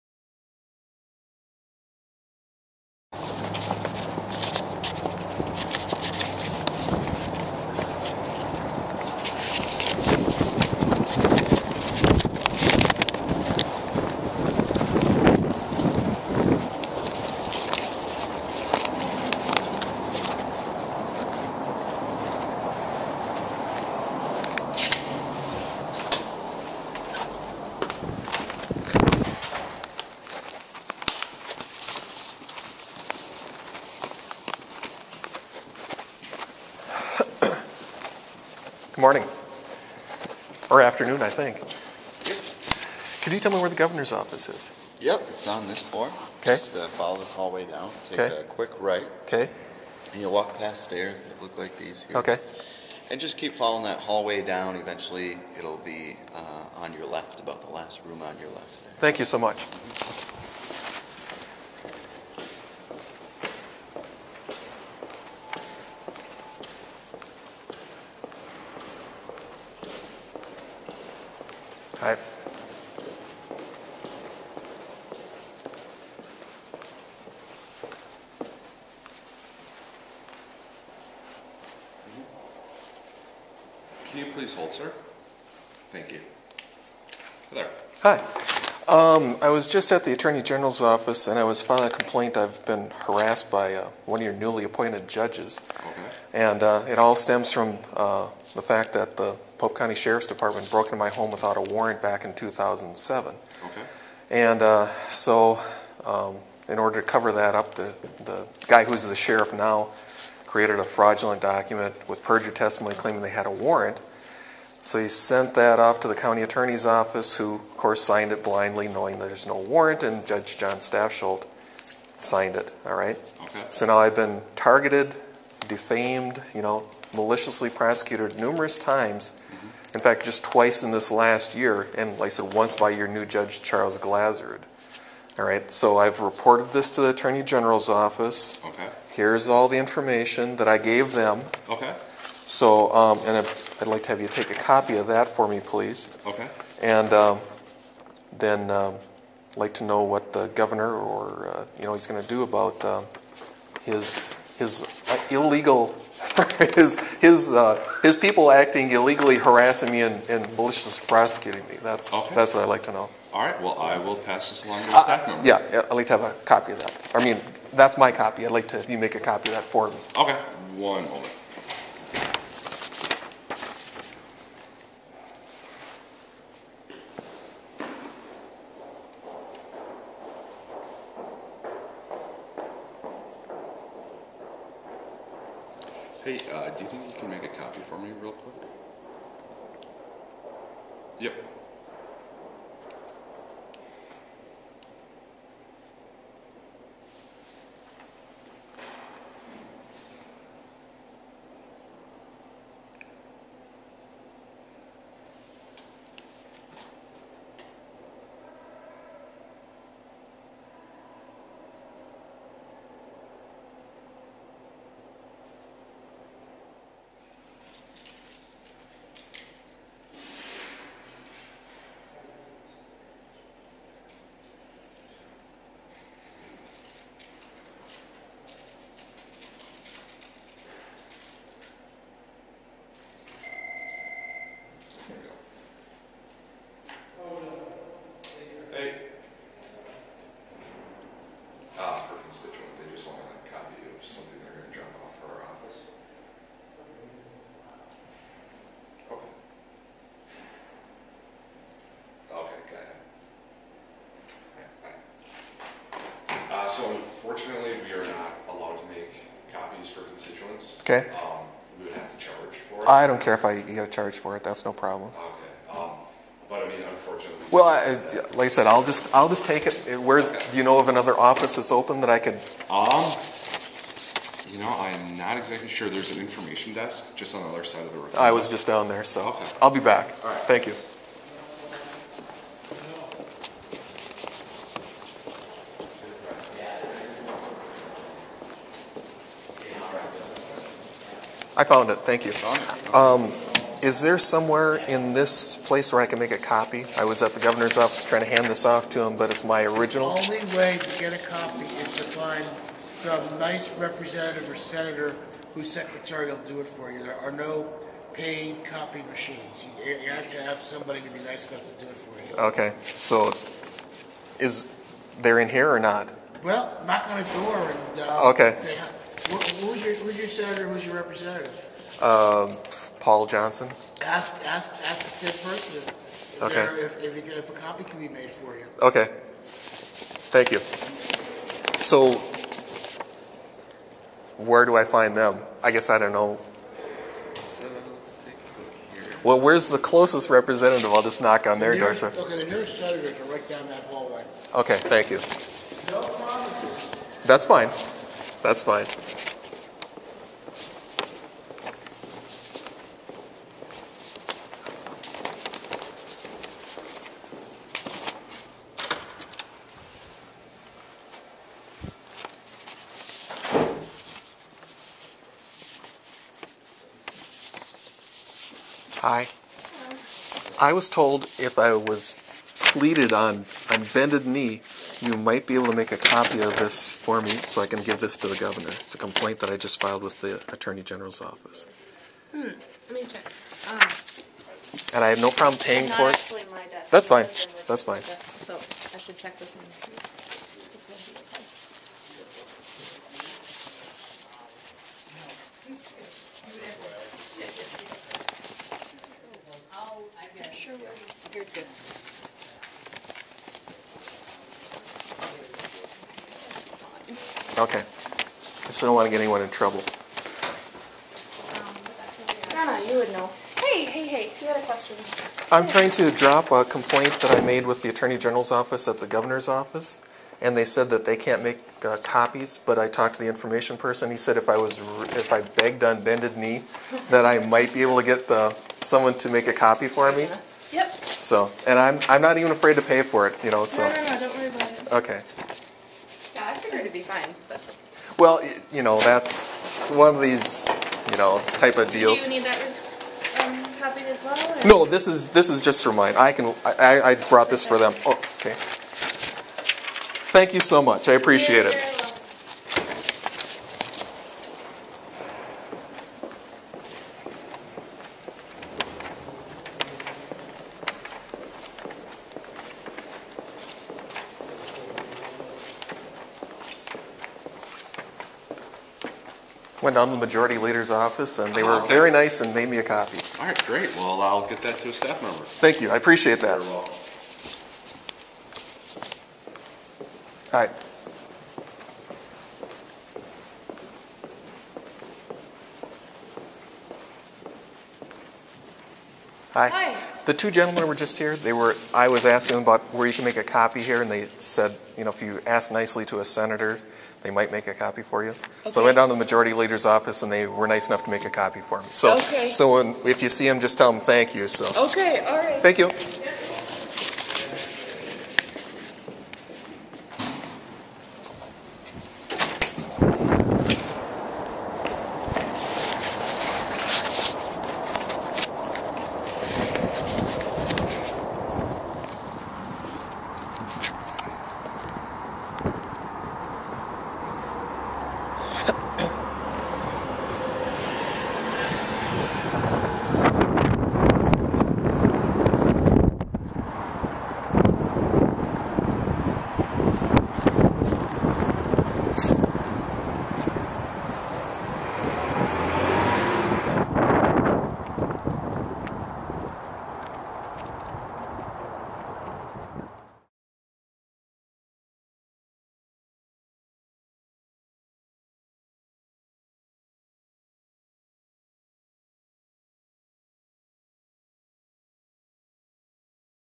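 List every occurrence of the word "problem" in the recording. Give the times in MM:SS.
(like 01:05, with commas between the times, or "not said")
04:24, 06:25.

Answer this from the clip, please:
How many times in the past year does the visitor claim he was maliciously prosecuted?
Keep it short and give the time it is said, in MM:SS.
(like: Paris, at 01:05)
twice, at 02:10.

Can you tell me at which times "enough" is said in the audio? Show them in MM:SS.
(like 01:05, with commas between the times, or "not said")
05:11, 08:20.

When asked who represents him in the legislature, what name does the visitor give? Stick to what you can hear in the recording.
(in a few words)
Paul Johnson.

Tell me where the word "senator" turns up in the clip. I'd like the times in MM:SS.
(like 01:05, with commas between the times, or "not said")
05:04, 05:20, 05:42, 08:16.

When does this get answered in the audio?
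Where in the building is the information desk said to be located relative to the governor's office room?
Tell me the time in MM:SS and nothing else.
04:37.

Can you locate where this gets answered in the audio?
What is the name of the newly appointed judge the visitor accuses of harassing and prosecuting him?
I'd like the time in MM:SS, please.
02:13.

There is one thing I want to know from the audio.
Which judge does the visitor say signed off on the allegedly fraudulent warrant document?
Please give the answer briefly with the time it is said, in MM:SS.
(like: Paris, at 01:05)
Jon Stafsholt, at 02:00.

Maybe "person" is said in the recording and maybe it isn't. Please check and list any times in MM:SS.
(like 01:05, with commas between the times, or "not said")
05:25, 07:03.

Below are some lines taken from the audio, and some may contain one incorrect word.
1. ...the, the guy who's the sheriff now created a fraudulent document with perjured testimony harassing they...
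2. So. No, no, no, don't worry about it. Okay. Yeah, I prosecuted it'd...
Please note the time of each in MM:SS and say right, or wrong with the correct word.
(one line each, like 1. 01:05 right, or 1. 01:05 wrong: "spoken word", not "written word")
1. 01:47 wrong: "claiming", not "harassing"
2. 07:13 wrong: "figured", not "prosecuted".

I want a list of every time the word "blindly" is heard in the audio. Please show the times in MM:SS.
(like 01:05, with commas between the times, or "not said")
01:58.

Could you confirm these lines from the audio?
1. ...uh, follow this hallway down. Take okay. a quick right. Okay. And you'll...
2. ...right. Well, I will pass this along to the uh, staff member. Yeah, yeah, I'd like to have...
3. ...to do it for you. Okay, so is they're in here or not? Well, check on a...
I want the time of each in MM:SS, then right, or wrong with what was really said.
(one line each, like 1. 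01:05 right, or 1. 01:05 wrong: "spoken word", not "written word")
1. 00:46 right
2. 02:43 right
3. 05:11 wrong: "knock", not "check".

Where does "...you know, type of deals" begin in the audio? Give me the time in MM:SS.
07:21.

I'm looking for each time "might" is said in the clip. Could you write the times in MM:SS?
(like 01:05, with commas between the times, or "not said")
06:15, 07:07, 08:17.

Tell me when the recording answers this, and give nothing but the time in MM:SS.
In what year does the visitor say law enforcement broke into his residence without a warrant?
01:42.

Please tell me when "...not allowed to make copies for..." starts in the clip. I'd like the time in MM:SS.
04:18.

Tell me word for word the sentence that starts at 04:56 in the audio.
I was at the governor's office trying to hand this off to him, but it's my original.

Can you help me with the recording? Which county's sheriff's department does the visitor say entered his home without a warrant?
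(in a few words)
Pope County.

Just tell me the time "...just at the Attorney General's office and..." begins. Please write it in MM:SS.
01:29.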